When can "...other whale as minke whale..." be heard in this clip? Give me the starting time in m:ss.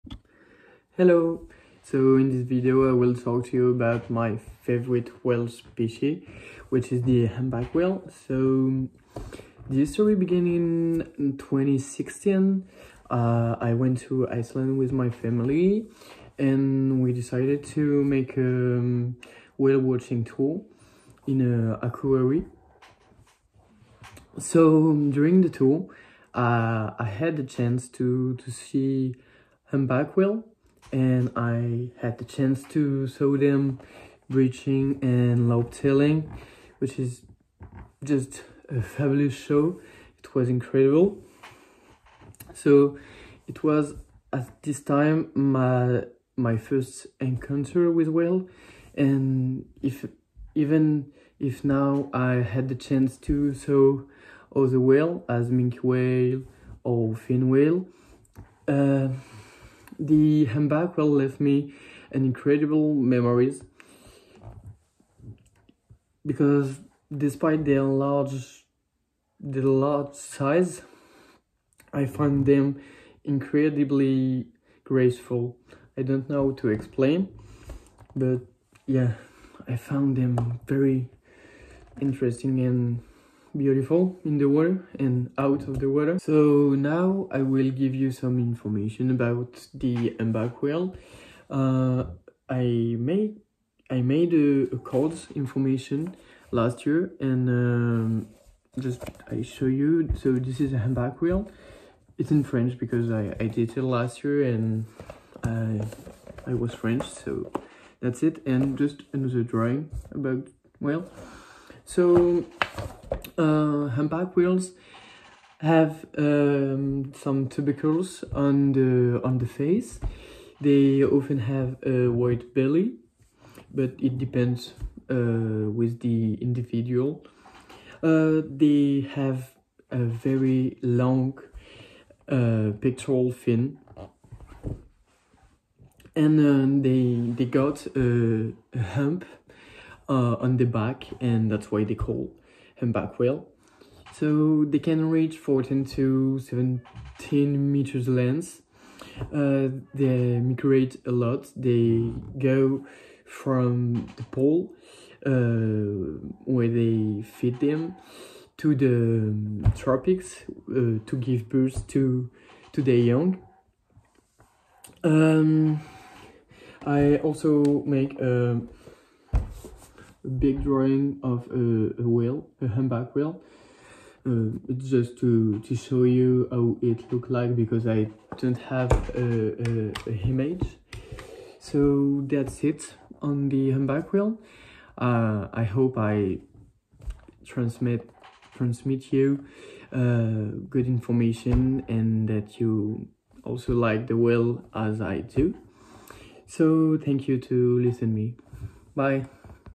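0:54.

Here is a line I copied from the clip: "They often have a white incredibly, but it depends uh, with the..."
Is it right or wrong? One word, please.
wrong.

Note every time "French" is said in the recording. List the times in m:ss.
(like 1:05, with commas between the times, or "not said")
1:42, 1:46.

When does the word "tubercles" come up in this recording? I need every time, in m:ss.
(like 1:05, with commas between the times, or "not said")
1:57.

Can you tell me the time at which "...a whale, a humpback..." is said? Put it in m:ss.
2:52.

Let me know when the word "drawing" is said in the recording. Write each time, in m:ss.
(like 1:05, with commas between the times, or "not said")
1:49, 2:50.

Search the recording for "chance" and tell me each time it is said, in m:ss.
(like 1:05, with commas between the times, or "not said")
0:27, 0:32, 0:52.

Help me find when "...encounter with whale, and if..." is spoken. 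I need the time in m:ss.
0:47.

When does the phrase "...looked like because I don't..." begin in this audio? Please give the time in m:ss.
2:57.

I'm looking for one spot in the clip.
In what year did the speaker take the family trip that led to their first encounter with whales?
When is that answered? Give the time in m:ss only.
0:11.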